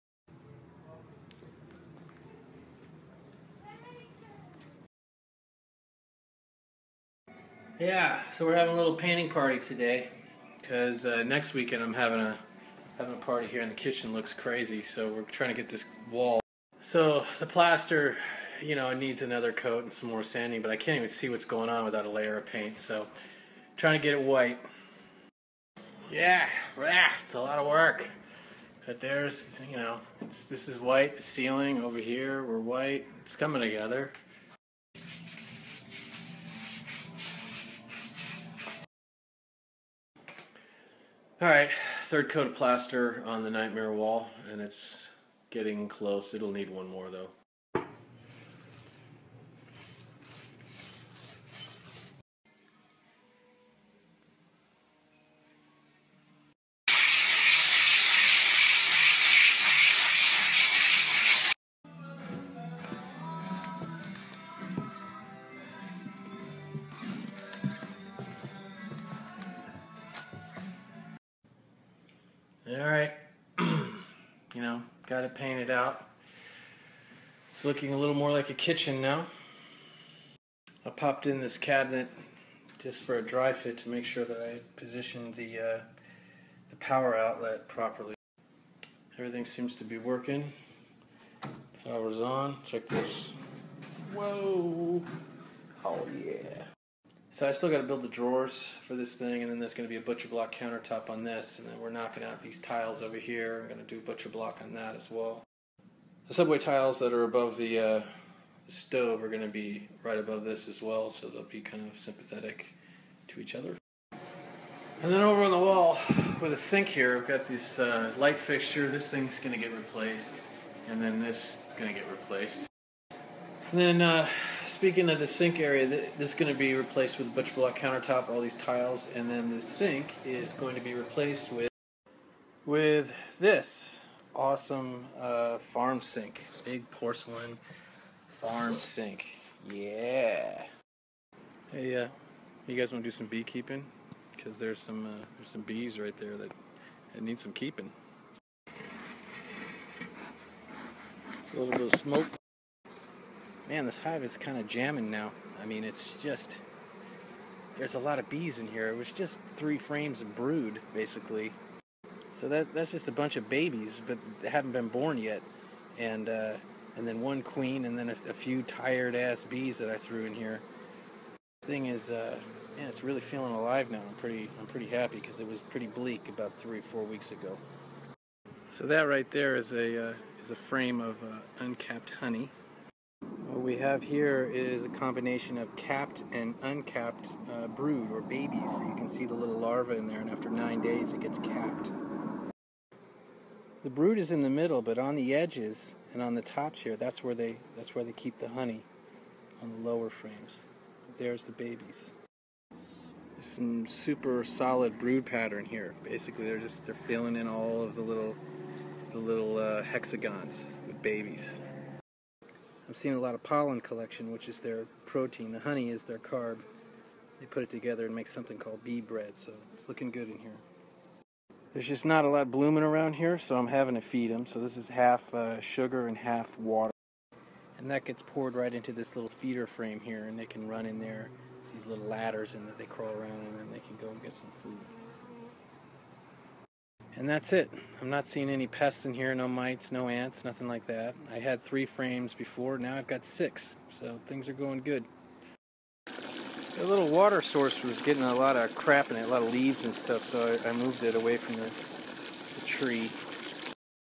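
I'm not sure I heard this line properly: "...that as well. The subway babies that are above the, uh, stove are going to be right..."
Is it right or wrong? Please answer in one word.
wrong.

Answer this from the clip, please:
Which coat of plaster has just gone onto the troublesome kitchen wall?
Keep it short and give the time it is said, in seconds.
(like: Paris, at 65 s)
Third, at 42 s.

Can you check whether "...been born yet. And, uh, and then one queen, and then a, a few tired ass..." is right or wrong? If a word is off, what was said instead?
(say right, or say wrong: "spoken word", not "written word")
right.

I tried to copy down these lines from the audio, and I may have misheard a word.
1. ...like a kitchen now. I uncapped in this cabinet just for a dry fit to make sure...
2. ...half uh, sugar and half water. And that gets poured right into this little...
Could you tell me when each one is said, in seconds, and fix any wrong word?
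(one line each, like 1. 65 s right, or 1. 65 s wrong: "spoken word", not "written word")
1. 78 s wrong: "popped", not "uncapped"
2. 224 s right.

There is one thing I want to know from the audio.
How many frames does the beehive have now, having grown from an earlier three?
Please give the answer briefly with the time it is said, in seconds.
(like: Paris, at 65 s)
6, at 243 s.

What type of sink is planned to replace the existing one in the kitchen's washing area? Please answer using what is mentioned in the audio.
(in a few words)
Porcelain farm sink.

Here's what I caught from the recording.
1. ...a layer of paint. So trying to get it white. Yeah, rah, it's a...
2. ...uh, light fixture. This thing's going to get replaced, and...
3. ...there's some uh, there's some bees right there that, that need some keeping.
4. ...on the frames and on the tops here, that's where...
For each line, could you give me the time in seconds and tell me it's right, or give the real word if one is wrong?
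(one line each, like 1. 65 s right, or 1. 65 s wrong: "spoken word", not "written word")
1. 22 s right
2. 117 s right
3. 144 s right
4. 194 s wrong: "edges", not "frames".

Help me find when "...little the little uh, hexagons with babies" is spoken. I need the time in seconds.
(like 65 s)
208 s.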